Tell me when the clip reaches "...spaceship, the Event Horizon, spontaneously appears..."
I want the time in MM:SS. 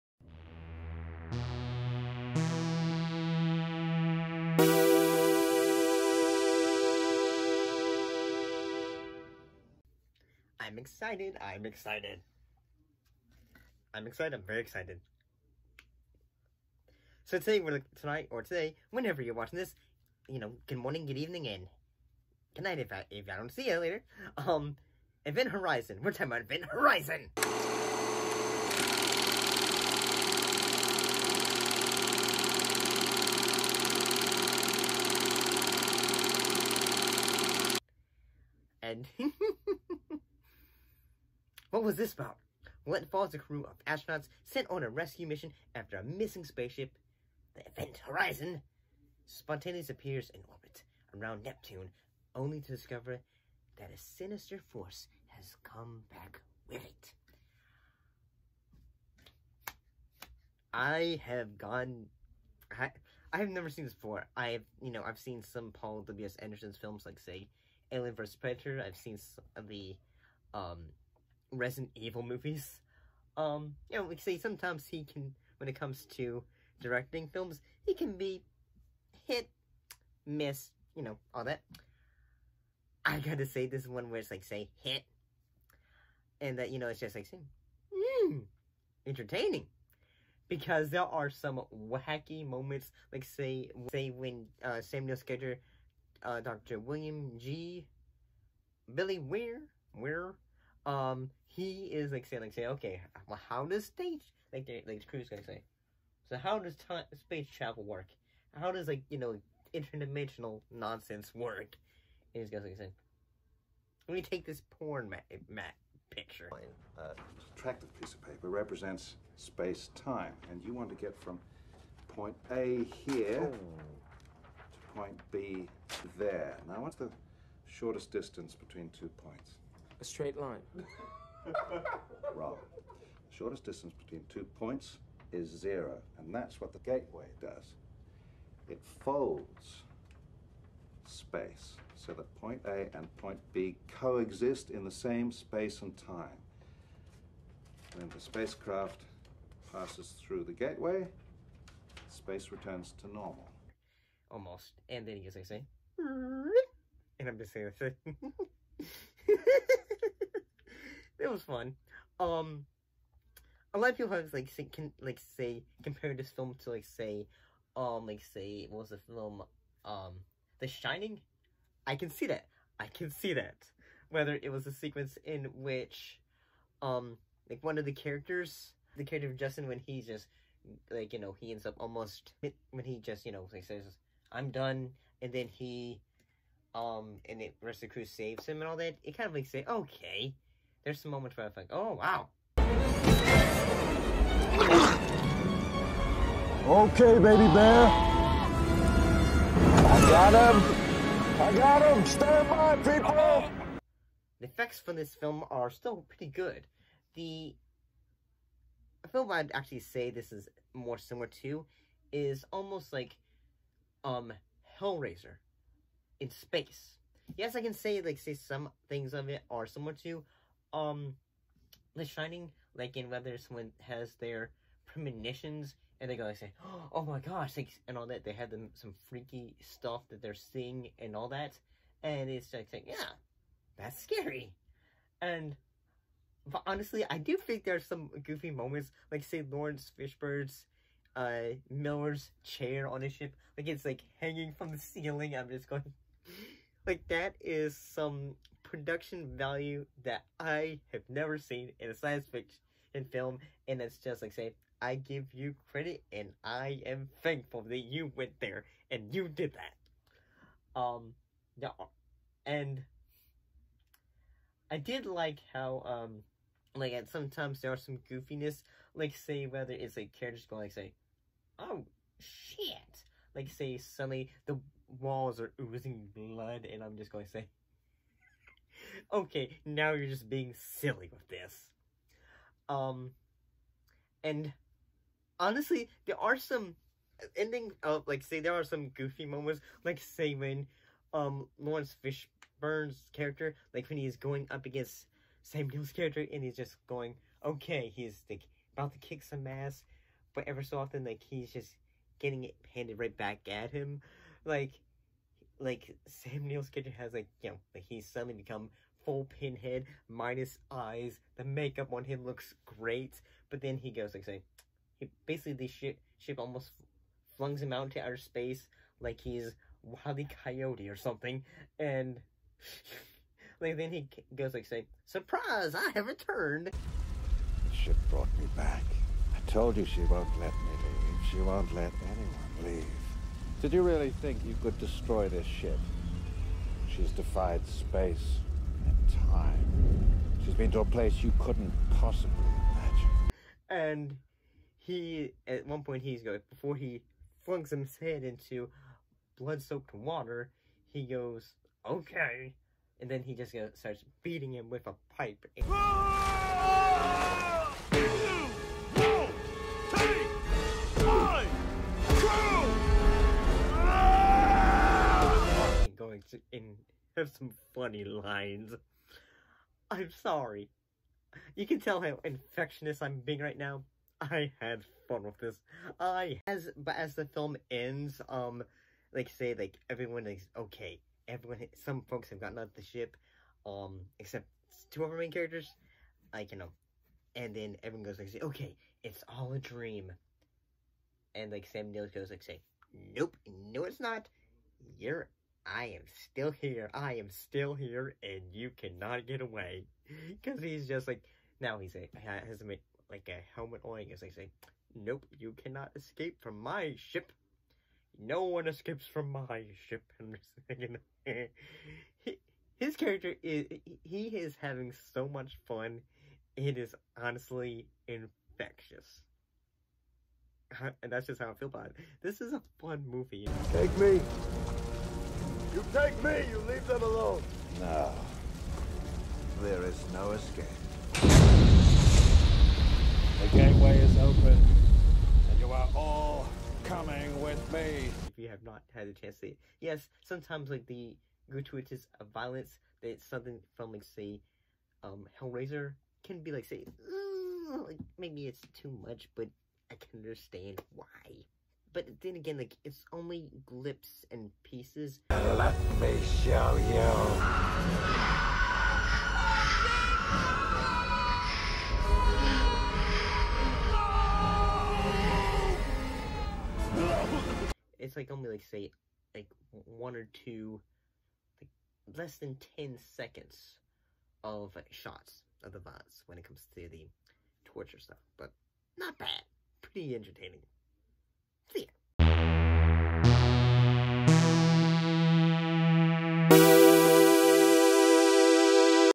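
00:46.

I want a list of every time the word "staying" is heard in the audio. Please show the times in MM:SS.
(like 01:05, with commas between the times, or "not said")
not said.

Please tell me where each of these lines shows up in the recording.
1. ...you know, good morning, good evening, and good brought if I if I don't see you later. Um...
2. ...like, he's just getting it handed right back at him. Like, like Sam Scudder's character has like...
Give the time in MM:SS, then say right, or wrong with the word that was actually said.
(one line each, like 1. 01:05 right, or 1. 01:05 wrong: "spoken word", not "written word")
1. 00:20 wrong: "night", not "brought"
2. 05:01 wrong: "Neill", not "Scudder".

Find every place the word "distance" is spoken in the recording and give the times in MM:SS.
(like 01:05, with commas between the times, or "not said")
02:08, 02:13.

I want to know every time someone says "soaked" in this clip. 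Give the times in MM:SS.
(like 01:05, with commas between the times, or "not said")
05:49.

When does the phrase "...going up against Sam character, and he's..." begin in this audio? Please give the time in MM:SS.
04:54.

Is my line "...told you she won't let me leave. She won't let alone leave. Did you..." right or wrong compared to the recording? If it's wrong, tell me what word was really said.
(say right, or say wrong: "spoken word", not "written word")
wrong: "anyone", not "alone".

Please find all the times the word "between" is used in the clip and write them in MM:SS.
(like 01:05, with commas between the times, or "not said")
02:08, 02:13.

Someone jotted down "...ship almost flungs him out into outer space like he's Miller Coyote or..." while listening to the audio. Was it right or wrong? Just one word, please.
wrong.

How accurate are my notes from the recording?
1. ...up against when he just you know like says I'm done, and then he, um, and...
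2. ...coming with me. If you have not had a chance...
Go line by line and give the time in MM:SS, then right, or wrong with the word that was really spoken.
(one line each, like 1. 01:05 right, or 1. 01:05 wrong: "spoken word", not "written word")
1. 03:01 wrong: "almost", not "against"
2. 07:16 right.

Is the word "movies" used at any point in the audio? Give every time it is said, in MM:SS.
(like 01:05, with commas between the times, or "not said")
01:12, 07:03.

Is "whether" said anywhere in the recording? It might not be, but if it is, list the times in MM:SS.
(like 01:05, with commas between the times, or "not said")
02:54, 03:43, 04:29.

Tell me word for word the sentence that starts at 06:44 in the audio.
He's like, nope, you cannot escape from my ship.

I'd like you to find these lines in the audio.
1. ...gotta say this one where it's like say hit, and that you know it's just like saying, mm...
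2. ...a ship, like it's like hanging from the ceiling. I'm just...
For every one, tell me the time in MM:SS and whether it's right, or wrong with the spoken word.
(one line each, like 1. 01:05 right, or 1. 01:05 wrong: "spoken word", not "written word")
1. 01:23 right
2. 04:03 right.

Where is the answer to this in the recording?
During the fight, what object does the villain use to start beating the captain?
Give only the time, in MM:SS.
05:55.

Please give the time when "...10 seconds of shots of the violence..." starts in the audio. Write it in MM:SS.
07:52.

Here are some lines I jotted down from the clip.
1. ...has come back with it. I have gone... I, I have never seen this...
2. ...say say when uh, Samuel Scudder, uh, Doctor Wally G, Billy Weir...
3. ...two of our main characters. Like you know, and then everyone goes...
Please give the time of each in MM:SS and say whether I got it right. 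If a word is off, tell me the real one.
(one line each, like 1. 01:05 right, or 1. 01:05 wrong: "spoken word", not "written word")
1. 00:55 right
2. 01:33 wrong: "William", not "Wally"
3. 06:24 right.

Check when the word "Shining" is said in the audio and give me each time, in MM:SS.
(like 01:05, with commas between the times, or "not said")
02:50, 03:42.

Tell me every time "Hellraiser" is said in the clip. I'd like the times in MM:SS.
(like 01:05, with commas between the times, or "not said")
03:34, 07:25.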